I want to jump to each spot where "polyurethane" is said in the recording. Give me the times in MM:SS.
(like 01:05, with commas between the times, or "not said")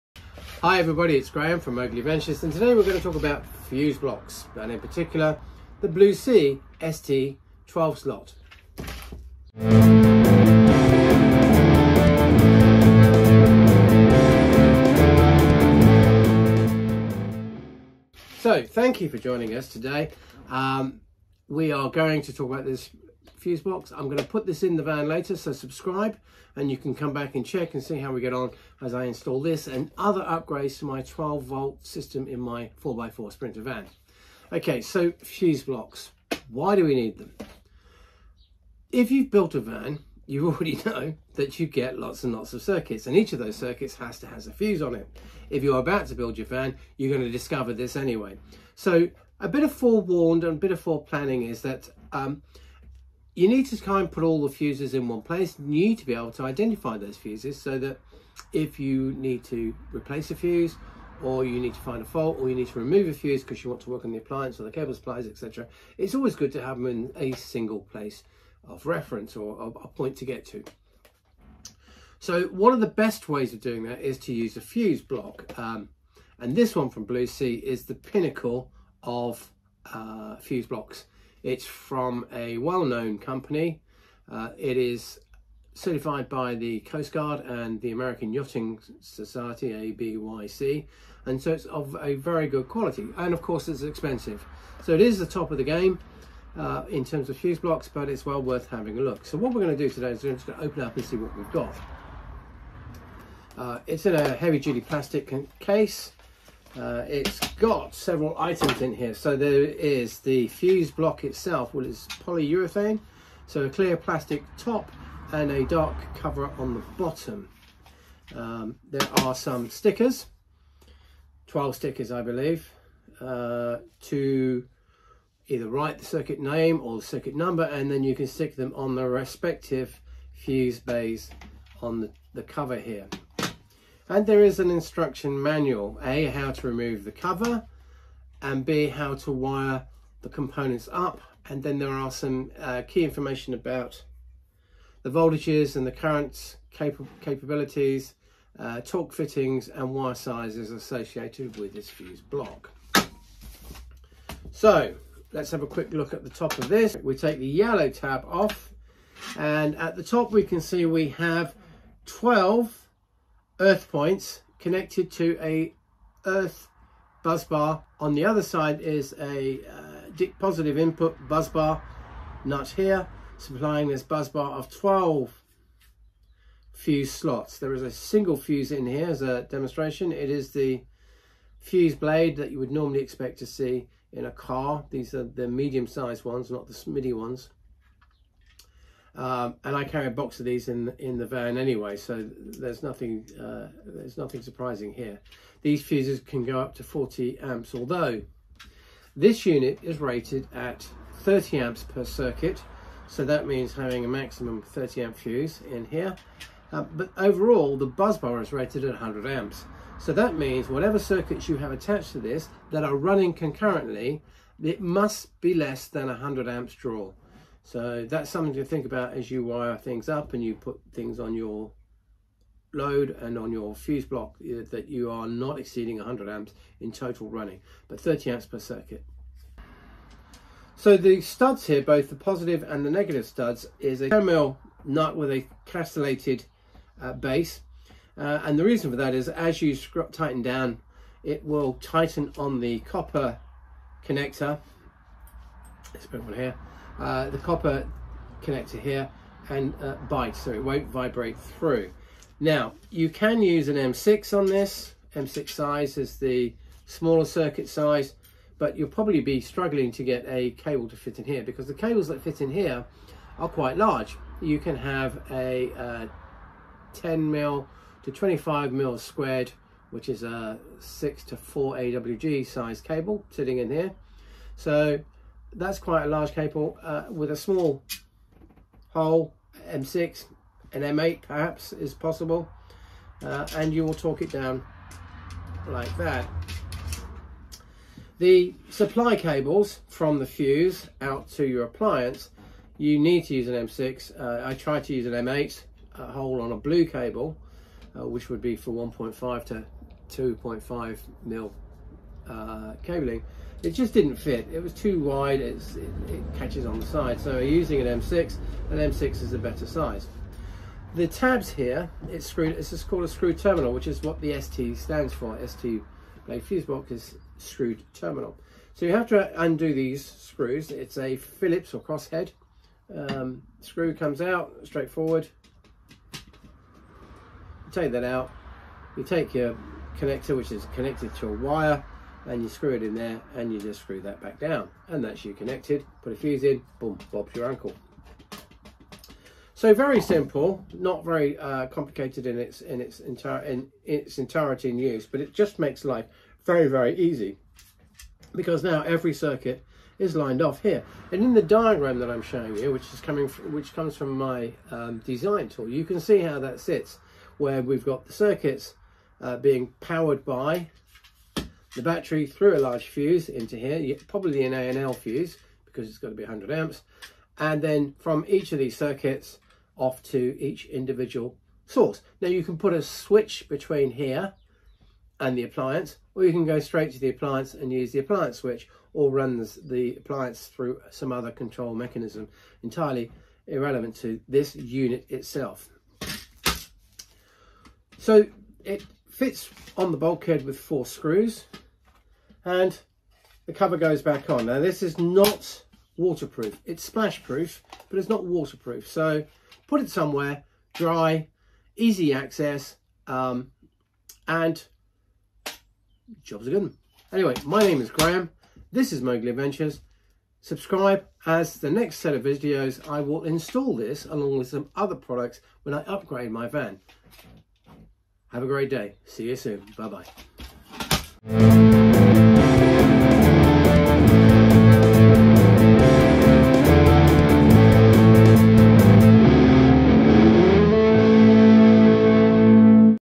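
01:52.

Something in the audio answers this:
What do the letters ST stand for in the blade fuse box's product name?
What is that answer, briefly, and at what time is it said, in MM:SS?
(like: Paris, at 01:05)
Screw terminal, at 05:17.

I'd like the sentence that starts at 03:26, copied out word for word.
Uh, but overall, the busbar is rated at 100 amps.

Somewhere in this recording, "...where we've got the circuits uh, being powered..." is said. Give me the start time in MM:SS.
05:57.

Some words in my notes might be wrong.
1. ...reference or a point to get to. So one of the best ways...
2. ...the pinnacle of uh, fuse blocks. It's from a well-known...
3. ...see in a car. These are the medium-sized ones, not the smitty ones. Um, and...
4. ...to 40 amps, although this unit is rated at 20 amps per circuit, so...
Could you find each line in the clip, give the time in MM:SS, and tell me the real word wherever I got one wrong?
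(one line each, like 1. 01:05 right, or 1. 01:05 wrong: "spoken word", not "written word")
1. 01:08 right
2. 01:17 right
3. 03:03 right
4. 03:16 wrong: "30", not "20".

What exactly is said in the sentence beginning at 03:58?
Uh, and the reason for that is as you tighten down, it will tighten on the copper connector.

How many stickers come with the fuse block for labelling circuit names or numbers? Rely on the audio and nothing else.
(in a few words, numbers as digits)
12.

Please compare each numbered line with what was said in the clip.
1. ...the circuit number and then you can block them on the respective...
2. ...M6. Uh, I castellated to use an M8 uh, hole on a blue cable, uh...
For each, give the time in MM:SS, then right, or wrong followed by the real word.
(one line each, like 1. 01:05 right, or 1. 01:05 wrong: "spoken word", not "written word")
1. 02:06 wrong: "stick", not "block"
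2. 04:53 wrong: "tried", not "castellated".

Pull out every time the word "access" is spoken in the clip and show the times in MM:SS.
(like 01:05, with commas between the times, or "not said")
06:42.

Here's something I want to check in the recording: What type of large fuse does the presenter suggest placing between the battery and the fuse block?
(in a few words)
ANL fuse.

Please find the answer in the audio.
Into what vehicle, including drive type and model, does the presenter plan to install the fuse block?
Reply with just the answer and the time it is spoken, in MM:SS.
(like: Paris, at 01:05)
4x4 Sprinter van, at 00:32.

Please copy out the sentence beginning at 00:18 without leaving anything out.
So thank you for joining us today.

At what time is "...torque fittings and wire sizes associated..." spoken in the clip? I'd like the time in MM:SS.
02:28.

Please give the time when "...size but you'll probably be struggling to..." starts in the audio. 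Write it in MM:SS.
04:17.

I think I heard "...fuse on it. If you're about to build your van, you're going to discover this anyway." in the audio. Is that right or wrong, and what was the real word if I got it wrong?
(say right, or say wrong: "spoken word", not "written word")
right.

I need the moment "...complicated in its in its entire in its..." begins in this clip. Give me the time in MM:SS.
05:41.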